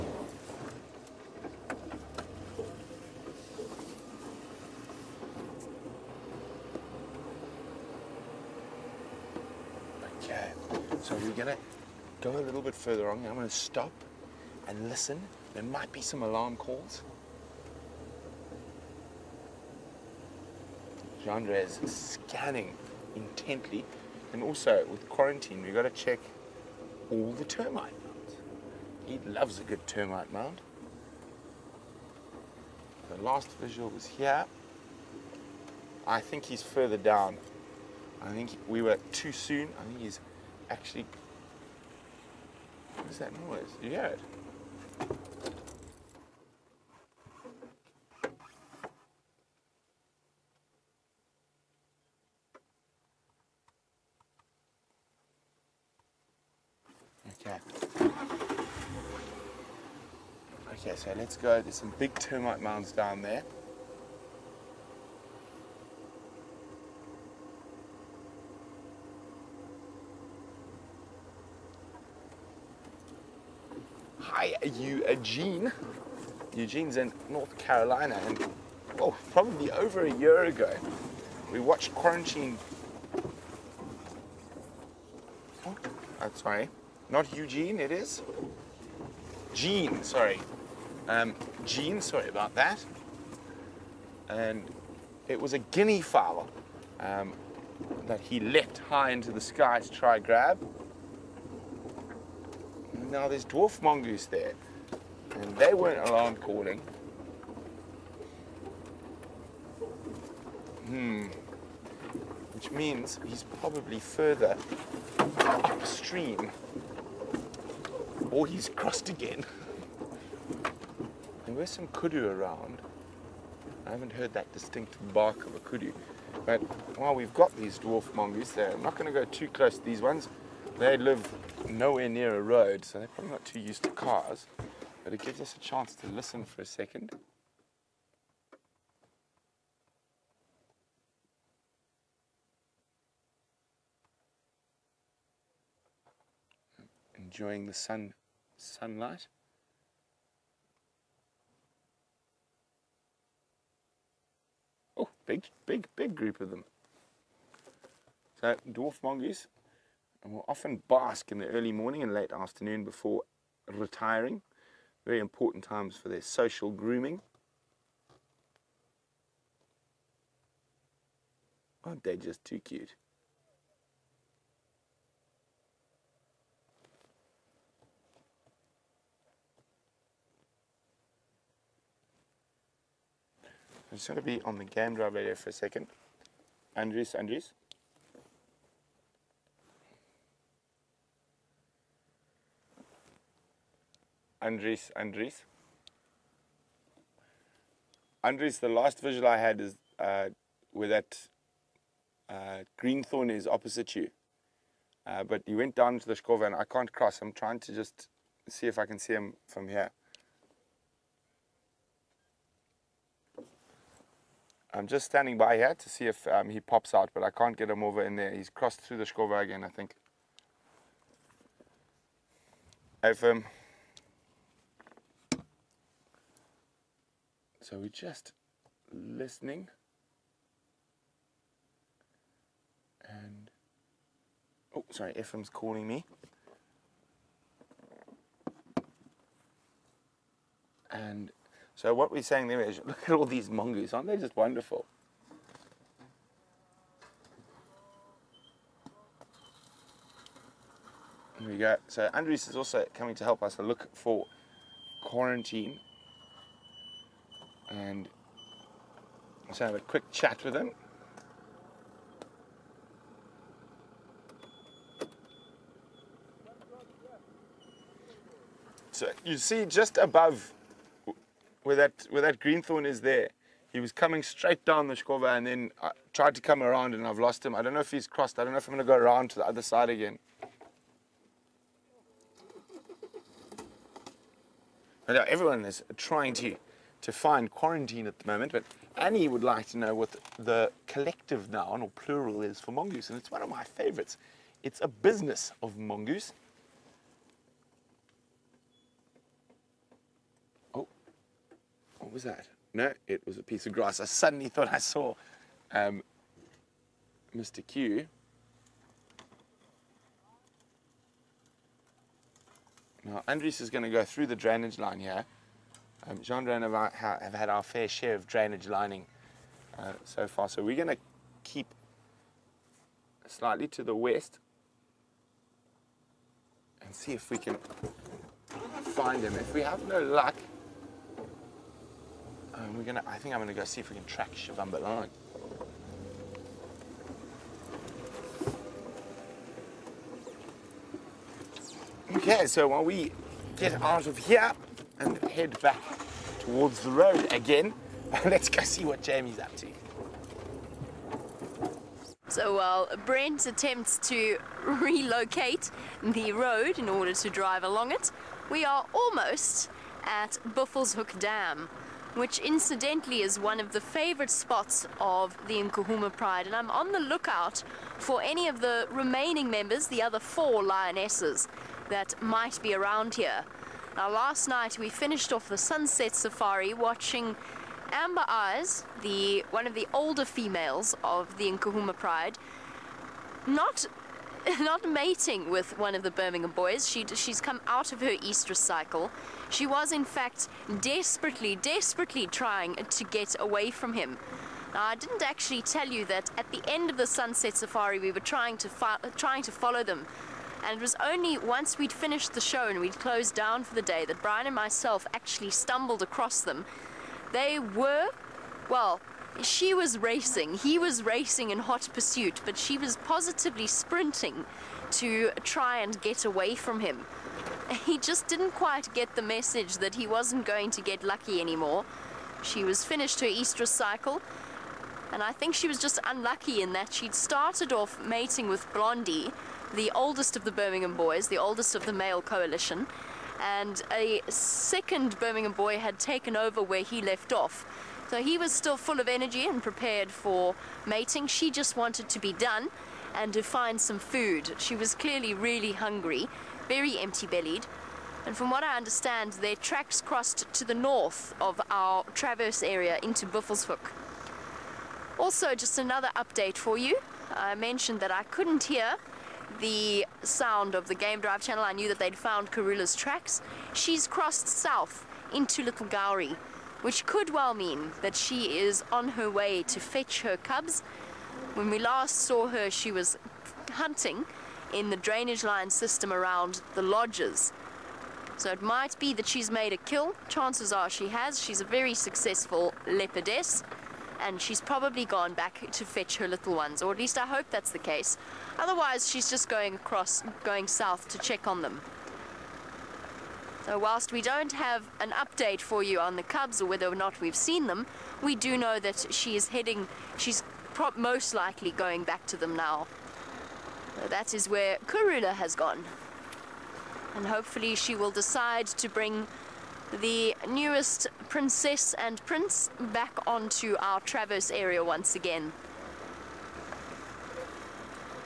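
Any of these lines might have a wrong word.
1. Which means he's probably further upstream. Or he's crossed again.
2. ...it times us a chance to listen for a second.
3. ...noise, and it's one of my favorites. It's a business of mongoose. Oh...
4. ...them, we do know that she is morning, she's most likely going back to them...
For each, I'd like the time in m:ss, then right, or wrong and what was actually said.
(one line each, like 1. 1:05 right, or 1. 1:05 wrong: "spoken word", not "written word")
1. 1:52 right
2. 2:15 wrong: "gives", not "times"
3. 4:52 wrong: "mongoose", not "noise"
4. 8:17 wrong: "heading", not "morning".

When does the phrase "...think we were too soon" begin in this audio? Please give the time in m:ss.
0:38.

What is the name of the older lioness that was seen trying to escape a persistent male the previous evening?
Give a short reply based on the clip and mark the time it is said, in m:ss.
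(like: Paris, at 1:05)
Amber Eyes, at 6:17.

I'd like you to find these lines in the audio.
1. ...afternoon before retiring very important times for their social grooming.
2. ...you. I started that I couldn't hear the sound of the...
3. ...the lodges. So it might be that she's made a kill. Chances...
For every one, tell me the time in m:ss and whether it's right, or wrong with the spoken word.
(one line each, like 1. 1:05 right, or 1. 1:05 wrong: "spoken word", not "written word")
1. 2:42 right
2. 7:36 wrong: "mentioned", not "started"
3. 7:56 right.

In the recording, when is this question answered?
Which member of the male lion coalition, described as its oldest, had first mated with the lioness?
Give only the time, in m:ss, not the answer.
7:08.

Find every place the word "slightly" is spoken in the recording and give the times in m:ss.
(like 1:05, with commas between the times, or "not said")
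5:23.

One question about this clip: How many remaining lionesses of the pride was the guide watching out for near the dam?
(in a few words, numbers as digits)
4.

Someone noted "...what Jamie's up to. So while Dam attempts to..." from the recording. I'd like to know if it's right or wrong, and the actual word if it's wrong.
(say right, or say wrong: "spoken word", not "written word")
wrong: "Brent", not "Dam".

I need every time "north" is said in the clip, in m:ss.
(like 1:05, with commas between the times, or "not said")
1:17, 7:30.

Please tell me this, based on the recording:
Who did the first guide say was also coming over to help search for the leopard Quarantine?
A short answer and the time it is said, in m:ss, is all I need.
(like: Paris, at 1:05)
Andrews, at 4:12.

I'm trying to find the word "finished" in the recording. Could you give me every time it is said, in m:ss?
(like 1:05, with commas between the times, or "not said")
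6:14, 6:41, 7:02.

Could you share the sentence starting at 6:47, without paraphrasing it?
They were, well, she was racing.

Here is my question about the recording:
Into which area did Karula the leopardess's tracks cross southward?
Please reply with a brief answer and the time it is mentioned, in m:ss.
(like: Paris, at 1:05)
Little Gowrie, at 7:45.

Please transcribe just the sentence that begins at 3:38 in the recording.
He's crossed through the Shkova again, I think.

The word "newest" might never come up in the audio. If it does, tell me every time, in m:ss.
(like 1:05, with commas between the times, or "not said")
8:30.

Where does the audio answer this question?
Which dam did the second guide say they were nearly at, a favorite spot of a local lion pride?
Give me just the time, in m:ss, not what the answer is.
6:00.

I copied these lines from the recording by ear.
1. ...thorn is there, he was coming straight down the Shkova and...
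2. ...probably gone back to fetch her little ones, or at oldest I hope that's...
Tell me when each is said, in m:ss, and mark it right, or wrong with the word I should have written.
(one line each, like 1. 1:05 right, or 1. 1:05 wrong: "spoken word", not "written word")
1. 4:32 right
2. 8:04 wrong: "least", not "oldest".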